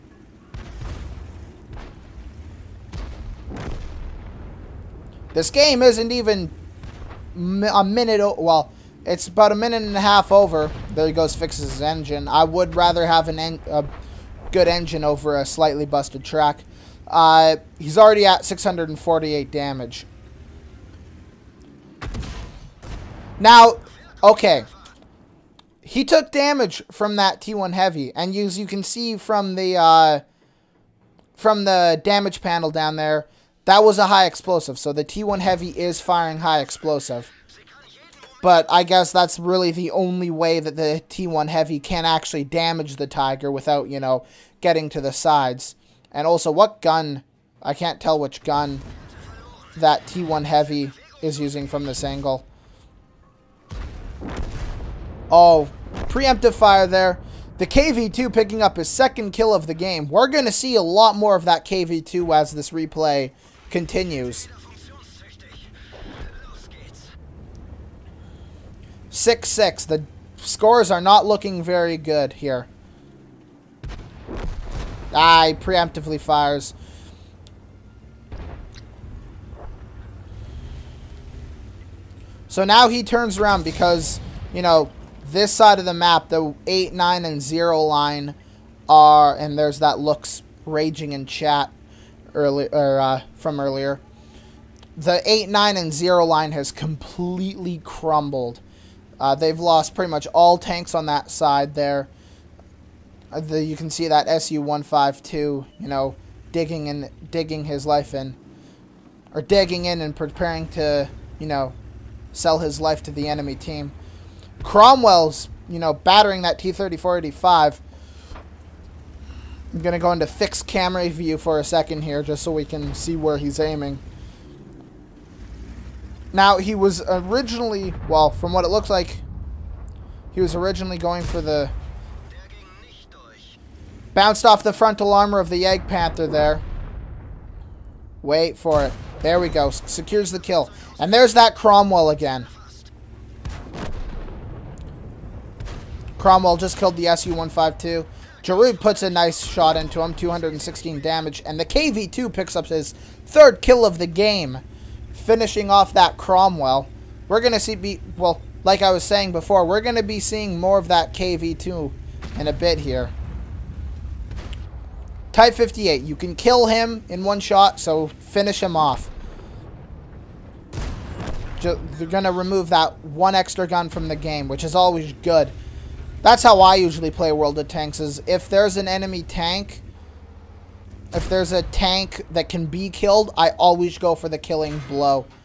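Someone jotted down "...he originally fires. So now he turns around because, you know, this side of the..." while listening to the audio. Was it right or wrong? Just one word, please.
wrong.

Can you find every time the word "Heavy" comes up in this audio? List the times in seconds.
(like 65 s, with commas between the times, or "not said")
27 s, 35 s, 41 s, 50 s.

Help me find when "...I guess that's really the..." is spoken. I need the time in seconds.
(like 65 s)
38 s.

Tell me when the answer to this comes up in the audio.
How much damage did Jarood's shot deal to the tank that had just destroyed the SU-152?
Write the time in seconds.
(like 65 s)
150 s.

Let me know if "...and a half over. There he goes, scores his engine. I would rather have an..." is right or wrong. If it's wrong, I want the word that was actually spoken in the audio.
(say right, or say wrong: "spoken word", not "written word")
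wrong: "fixes", not "scores".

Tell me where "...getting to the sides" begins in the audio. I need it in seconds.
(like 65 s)
44 s.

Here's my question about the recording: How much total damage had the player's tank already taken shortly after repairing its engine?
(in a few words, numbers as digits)
648.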